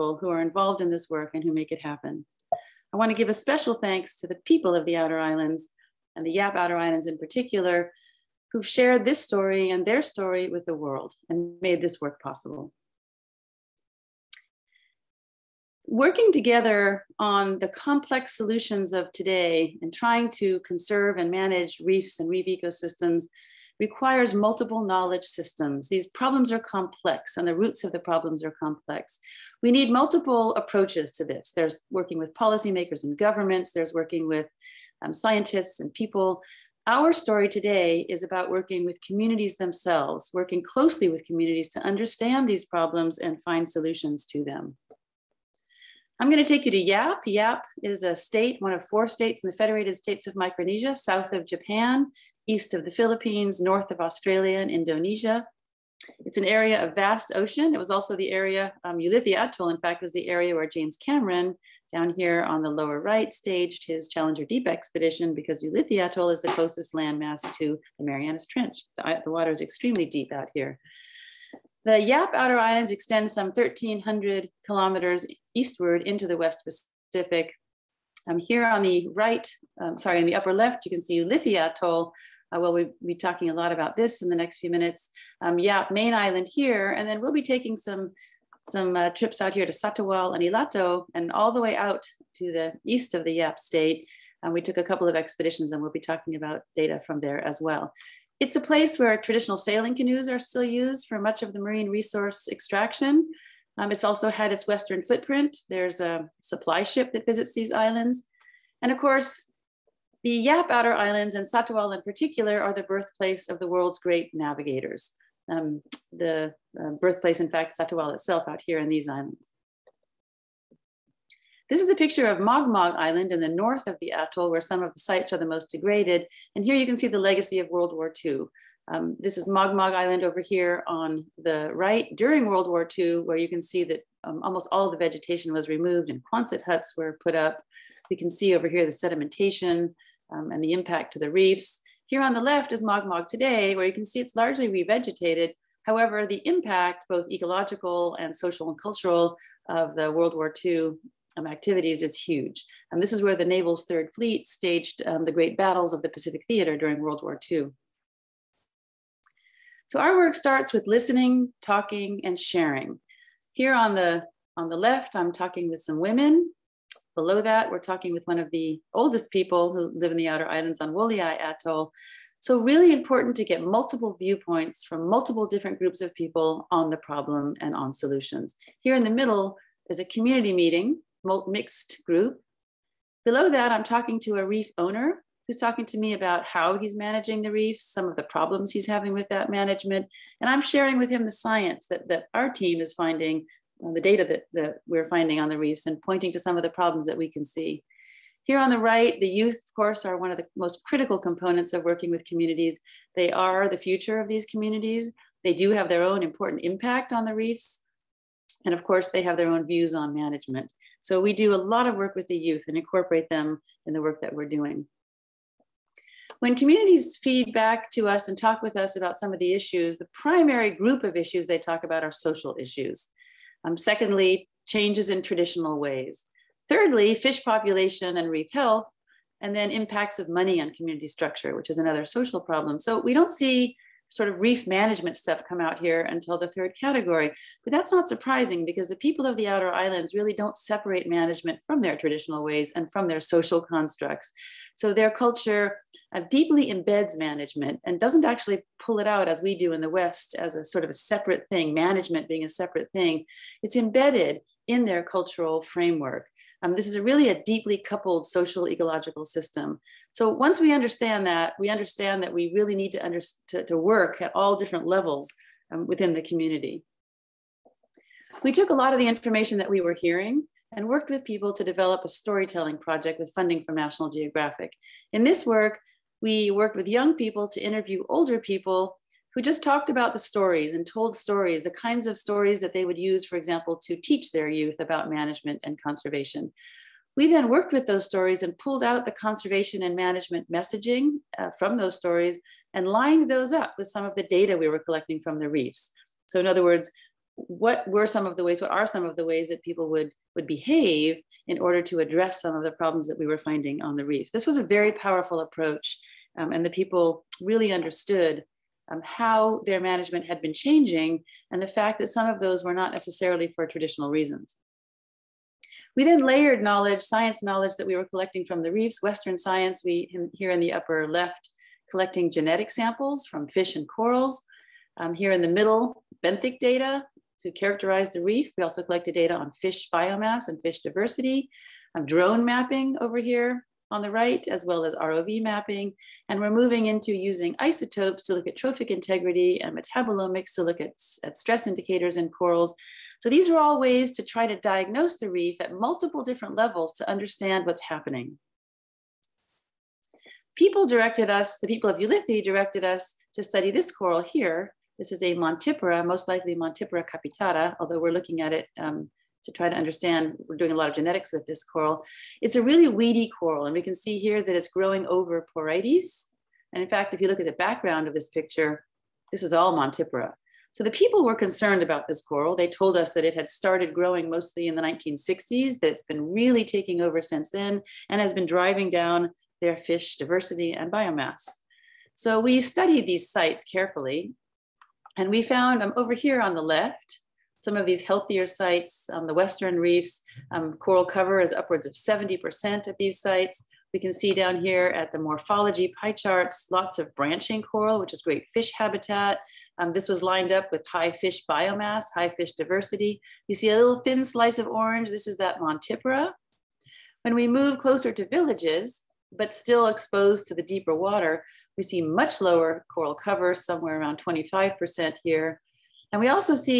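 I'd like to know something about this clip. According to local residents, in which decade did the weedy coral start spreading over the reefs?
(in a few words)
1960s.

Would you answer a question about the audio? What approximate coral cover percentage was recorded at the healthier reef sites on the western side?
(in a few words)
70%.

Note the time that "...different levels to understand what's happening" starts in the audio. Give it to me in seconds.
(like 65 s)
346 s.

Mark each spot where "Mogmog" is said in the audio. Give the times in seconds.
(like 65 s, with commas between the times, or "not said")
122 s, 129 s.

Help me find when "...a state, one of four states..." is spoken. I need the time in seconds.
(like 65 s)
48 s.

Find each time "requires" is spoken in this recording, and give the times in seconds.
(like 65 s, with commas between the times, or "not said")
23 s.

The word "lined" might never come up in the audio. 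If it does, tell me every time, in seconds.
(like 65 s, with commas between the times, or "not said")
292 s, 400 s.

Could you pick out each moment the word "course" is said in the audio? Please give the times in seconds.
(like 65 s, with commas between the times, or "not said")
108 s, 199 s, 208 s.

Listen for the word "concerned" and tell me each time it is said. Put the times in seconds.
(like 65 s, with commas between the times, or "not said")
371 s.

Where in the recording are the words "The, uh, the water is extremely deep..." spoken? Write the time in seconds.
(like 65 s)
68 s.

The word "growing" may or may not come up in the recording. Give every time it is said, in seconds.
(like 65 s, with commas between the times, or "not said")
364 s, 373 s.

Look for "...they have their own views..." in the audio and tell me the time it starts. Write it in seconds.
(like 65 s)
209 s.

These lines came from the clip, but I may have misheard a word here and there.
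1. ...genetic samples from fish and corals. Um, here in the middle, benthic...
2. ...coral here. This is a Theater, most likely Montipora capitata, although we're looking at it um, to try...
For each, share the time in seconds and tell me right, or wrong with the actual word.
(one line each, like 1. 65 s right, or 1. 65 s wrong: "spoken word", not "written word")
1. 322 s right
2. 353 s wrong: "Montipora", not "Theater".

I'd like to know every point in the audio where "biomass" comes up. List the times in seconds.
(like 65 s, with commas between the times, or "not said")
329 s, 380 s, 401 s.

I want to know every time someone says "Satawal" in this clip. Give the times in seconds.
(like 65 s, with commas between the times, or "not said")
89 s, 111 s, 117 s.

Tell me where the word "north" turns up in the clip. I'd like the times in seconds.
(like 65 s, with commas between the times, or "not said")
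53 s, 123 s.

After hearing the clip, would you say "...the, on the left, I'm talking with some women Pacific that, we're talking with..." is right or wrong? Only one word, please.
wrong.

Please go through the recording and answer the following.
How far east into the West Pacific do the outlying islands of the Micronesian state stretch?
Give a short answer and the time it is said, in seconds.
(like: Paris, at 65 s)
1,300 kilometers, at 73 s.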